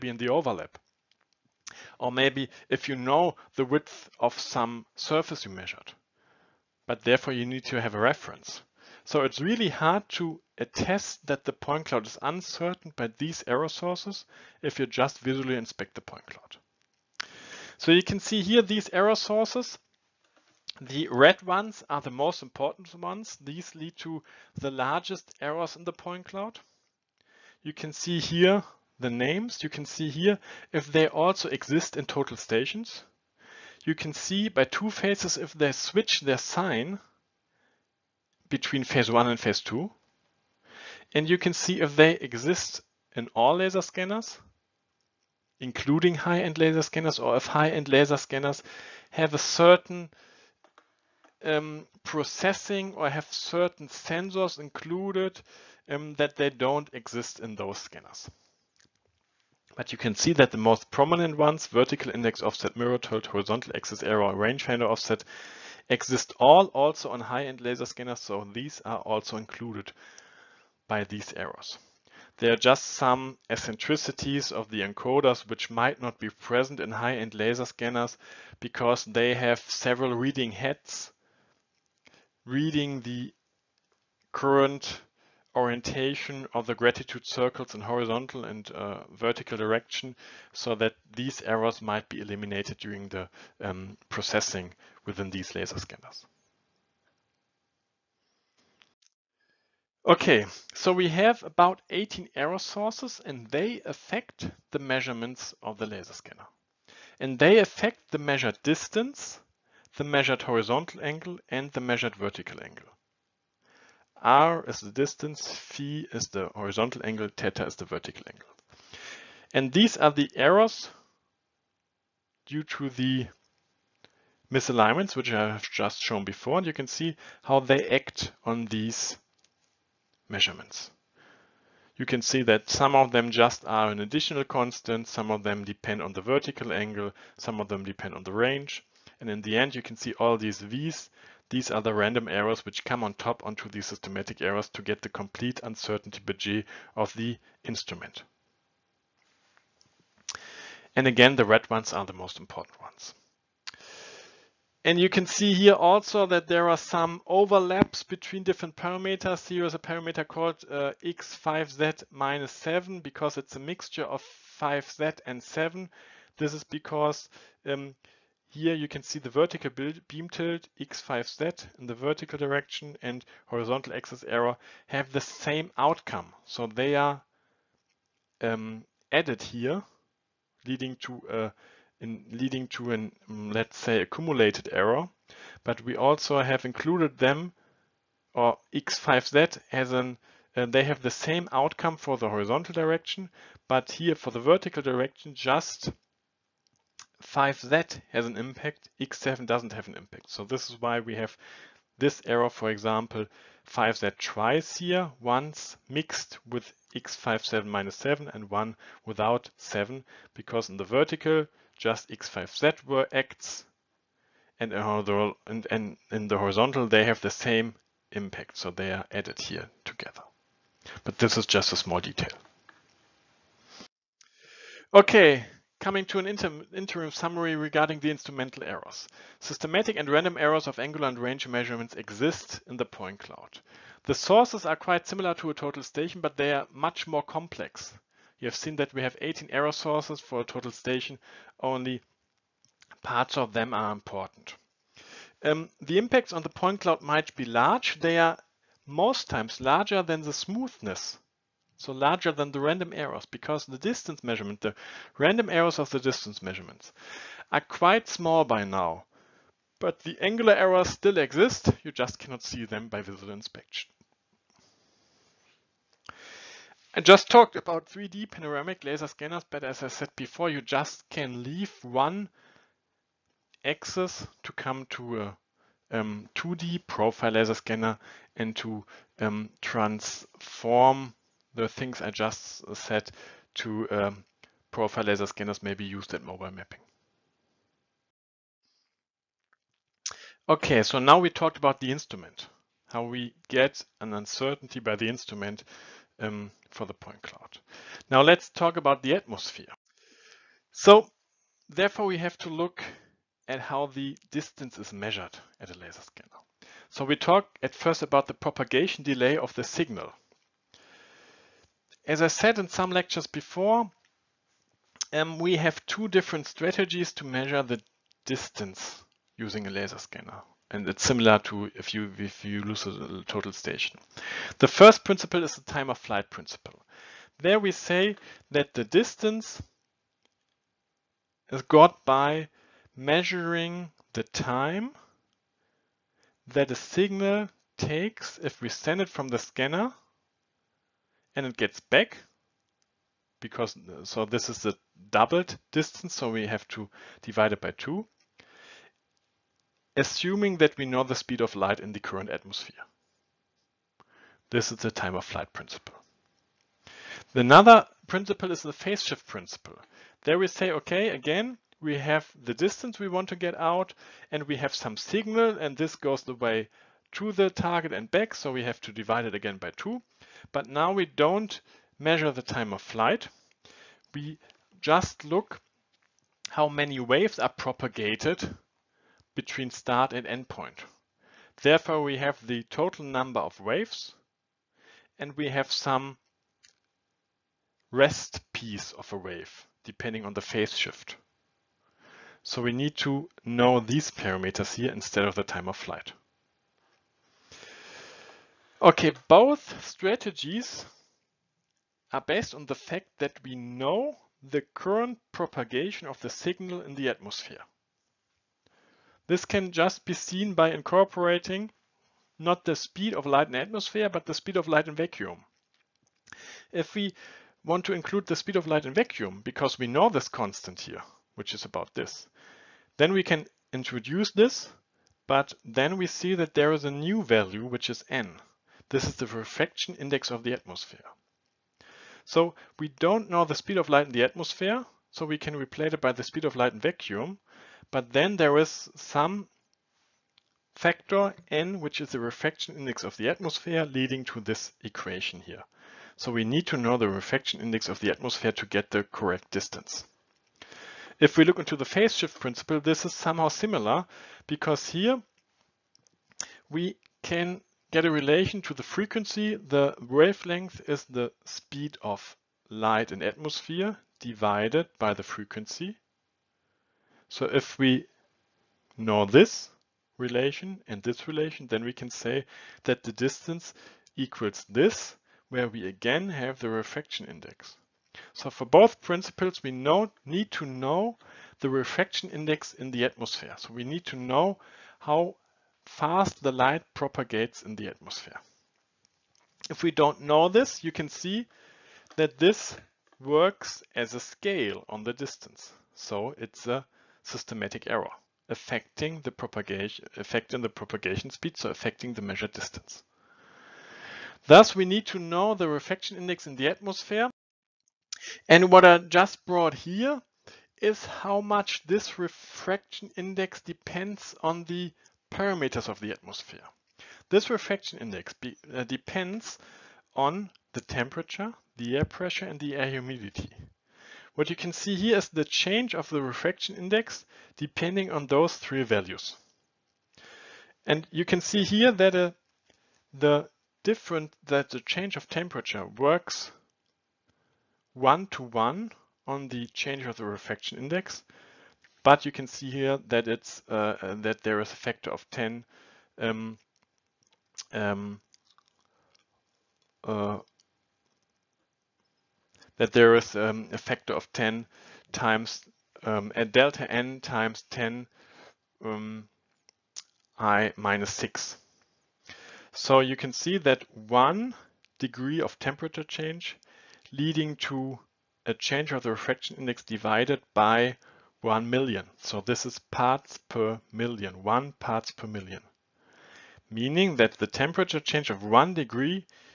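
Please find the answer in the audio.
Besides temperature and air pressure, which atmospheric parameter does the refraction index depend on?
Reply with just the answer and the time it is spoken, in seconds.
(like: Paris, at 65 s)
Air humidity, at 522 s.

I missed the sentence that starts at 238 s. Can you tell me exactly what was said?
You have seen that we have 18 error sources for a total station, only parts of them are important.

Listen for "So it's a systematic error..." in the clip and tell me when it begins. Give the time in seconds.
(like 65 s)
495 s.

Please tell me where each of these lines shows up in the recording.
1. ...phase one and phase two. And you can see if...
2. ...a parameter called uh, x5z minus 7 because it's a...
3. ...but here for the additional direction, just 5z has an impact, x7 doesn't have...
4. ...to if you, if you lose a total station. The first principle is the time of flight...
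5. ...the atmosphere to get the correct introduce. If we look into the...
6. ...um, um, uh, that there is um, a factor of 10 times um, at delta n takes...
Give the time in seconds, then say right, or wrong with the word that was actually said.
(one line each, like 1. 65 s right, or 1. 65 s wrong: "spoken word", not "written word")
1. 38 s right
2. 159 s right
3. 193 s wrong: "vertical", not "additional"
4. 321 s right
5. 447 s wrong: "distance", not "introduce"
6. 546 s wrong: "times", not "takes".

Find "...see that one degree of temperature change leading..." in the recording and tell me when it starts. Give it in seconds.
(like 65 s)
563 s.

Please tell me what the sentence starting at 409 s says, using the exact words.
This can just be seen by incorporating not the speed of light in atmosphere, but the speed of light in vacuum.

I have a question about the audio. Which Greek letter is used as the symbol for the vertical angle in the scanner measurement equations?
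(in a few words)
Theta.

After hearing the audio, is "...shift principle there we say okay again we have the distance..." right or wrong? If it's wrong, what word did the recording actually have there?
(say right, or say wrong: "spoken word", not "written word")
right.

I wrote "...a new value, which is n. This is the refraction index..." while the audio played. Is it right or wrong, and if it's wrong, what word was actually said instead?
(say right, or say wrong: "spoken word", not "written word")
right.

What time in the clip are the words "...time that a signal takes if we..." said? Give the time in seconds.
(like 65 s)
334 s.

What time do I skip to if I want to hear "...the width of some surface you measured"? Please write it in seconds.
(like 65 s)
3 s.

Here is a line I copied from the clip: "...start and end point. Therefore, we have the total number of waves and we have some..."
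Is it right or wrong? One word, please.
right.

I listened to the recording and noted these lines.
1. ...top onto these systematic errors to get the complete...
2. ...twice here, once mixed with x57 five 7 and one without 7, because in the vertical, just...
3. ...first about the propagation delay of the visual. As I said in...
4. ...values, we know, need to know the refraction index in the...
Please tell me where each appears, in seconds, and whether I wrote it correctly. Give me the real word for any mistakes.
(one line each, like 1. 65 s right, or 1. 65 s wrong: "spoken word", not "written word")
1. 143 s right
2. 204 s right
3. 307 s wrong: "signal", not "visual"
4. 479 s wrong: "principles", not "values".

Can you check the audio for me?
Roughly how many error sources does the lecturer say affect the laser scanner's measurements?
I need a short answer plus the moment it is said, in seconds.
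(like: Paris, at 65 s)
18, at 101 s.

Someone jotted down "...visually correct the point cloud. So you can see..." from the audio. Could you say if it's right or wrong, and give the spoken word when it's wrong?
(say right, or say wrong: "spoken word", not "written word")
wrong: "inspect", not "correct".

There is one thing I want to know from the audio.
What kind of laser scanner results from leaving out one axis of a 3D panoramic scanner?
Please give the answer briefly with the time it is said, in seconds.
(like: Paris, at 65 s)
2D profile laser scanner, at 276 s.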